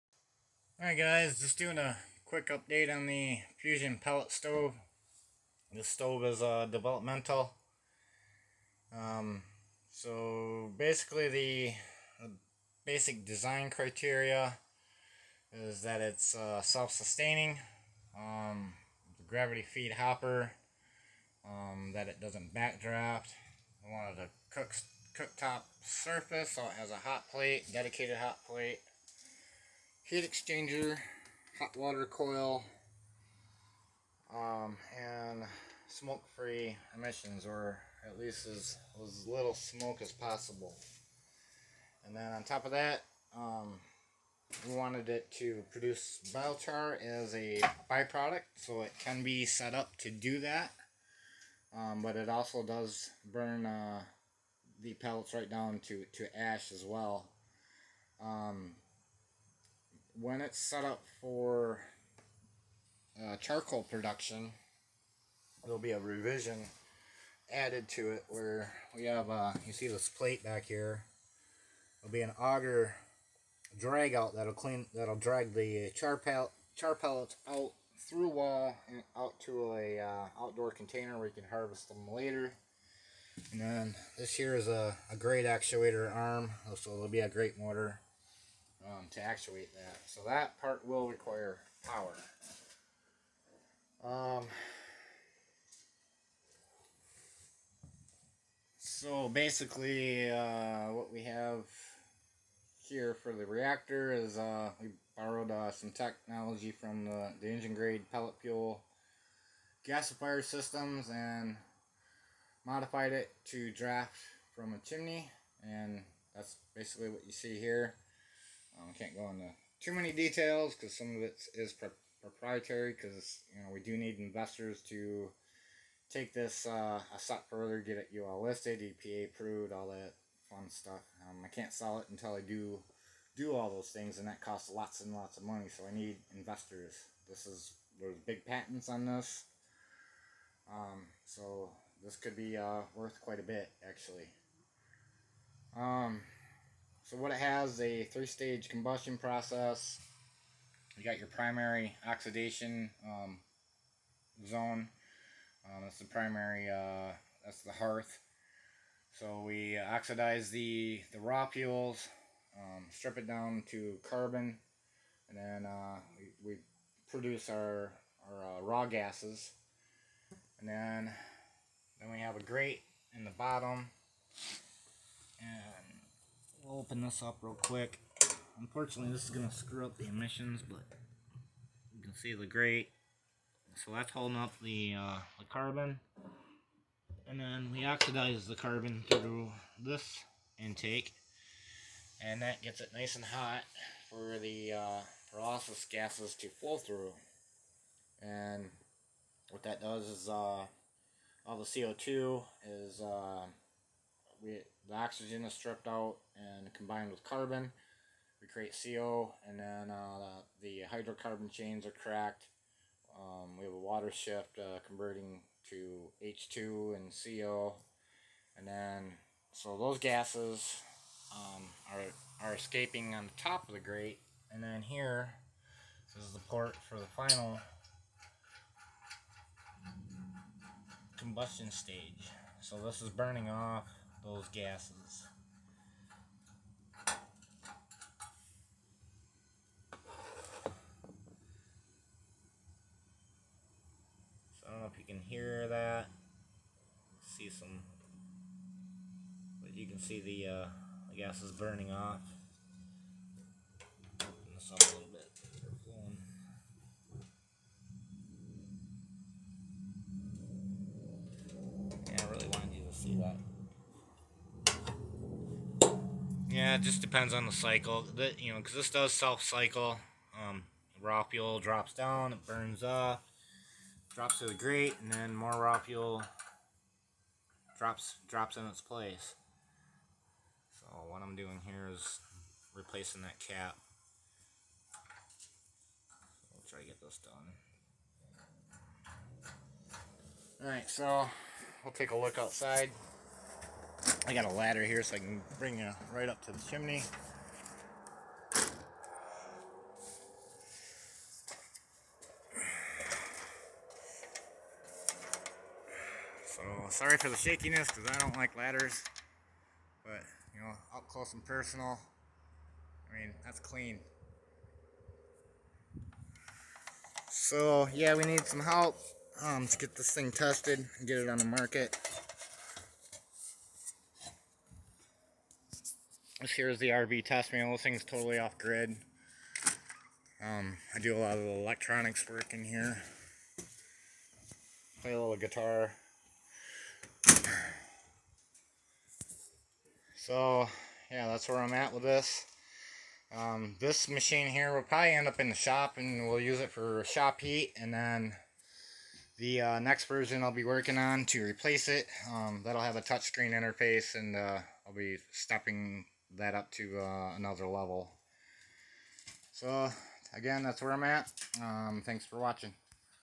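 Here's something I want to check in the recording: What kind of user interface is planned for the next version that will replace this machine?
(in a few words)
touchscreen interface.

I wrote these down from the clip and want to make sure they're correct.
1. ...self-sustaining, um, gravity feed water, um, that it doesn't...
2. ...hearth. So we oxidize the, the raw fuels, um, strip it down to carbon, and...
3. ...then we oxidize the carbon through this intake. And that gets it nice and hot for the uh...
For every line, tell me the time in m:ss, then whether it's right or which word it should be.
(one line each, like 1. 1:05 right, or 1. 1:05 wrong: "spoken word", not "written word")
1. 0:16 wrong: "hopper", not "water"
2. 2:37 right
3. 3:07 right.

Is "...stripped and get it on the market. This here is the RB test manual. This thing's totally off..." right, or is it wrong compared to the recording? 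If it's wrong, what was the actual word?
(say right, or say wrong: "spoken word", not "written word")
wrong: "tested", not "stripped".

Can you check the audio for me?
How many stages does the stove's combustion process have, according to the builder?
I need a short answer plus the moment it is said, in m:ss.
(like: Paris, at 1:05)
3, at 2:28.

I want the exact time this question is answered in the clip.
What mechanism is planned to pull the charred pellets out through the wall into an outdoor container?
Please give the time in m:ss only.
1:12.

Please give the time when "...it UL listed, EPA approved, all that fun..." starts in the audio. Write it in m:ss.
2:07.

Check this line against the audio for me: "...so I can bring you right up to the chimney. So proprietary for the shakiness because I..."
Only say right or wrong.
wrong.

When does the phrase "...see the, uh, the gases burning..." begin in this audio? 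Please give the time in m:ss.
4:09.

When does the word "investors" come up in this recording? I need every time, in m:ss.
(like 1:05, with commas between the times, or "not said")
2:04, 2:16.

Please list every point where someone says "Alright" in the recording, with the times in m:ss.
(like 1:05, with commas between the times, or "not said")
0:00, 4:50.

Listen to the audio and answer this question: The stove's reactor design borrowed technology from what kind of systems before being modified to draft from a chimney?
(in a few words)
engine grade pellet fuel gasifier systems.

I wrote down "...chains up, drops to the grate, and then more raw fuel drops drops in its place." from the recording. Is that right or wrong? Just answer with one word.
wrong.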